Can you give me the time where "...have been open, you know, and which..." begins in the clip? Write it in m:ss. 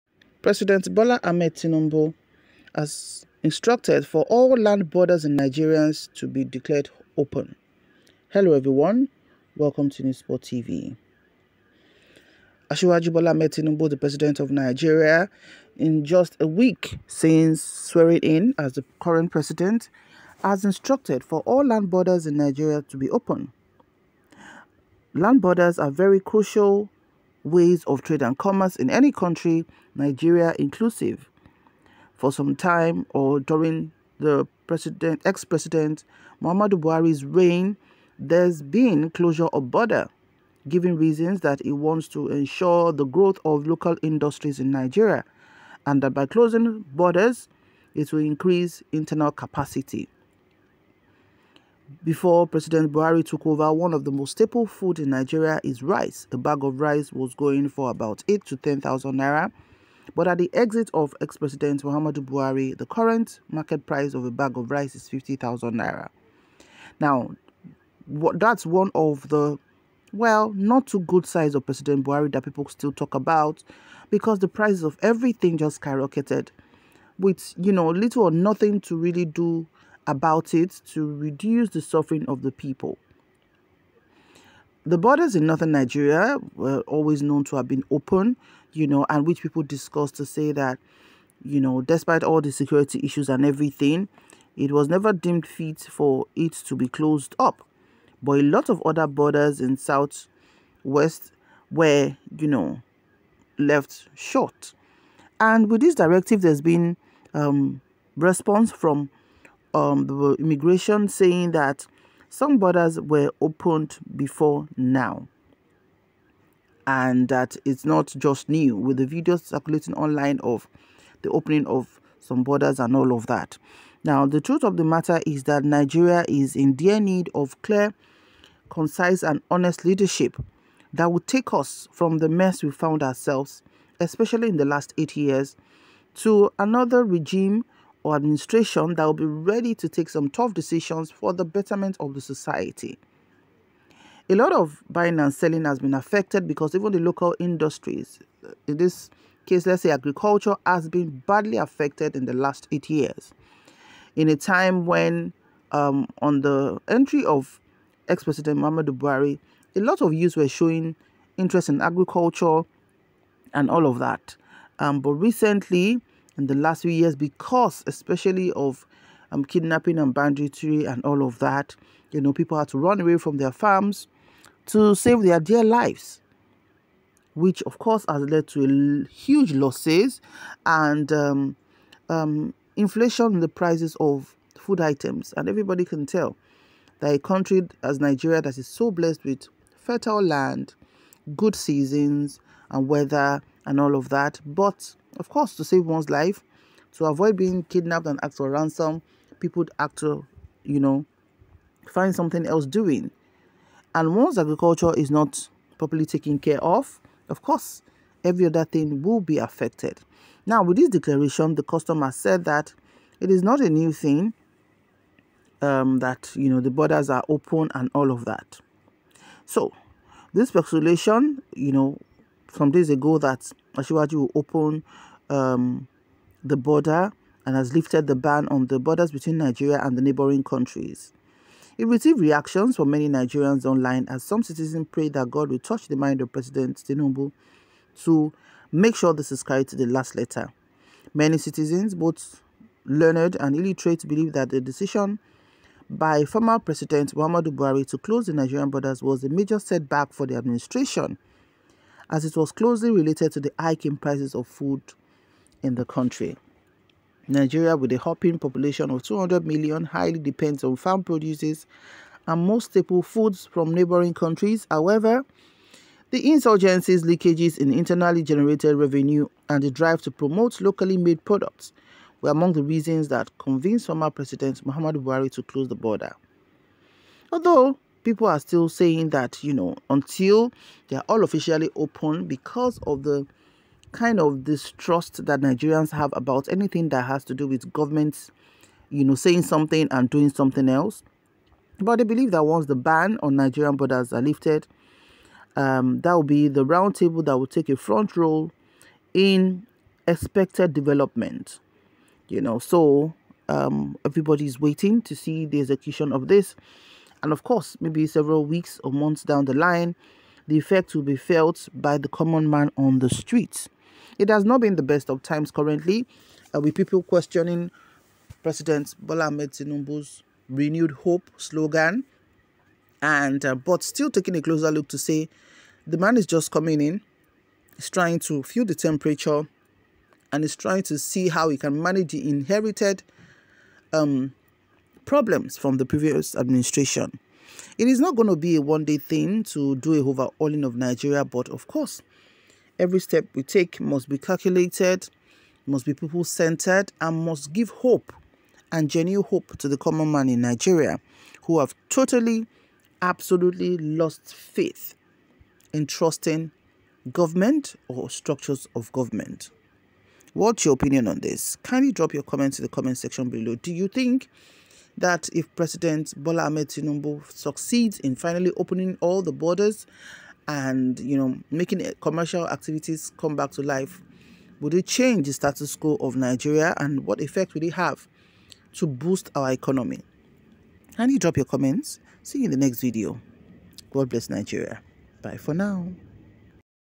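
1:27.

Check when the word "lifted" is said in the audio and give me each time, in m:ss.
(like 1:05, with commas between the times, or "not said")
3:47, 4:54.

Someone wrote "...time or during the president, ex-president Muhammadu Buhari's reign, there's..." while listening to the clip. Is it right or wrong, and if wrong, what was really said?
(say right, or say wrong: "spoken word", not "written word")
right.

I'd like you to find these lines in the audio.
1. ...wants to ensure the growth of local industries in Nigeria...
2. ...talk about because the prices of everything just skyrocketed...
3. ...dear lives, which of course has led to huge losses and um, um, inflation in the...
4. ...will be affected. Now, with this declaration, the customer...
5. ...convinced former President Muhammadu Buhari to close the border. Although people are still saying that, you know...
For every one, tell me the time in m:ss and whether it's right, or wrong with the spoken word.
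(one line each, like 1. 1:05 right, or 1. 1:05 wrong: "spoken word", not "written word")
1. 0:41 right
2. 1:12 right
3. 2:55 right
4. 3:29 right
5. 4:33 right.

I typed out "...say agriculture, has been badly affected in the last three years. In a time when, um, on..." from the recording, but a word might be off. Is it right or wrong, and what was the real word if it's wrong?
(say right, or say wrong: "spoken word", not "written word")
wrong: "eight", not "three".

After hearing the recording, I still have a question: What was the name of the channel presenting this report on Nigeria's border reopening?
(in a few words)
News Spot TV.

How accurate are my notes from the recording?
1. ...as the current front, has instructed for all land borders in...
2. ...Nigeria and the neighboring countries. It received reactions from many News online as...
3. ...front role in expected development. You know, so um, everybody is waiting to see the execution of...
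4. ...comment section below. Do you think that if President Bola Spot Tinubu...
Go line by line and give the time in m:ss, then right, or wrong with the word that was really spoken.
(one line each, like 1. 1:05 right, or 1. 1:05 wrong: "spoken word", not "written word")
1. 0:18 wrong: "president", not "front"
2. 3:49 wrong: "Nigerians", not "News"
3. 4:57 right
4. 6:02 wrong: "Ahmed", not "Spot".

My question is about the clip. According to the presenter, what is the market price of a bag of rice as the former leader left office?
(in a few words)
50,000 naira.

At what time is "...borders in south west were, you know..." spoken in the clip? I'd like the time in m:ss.
1:39.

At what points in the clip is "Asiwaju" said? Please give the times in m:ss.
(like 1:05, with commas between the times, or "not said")
0:12, 3:43.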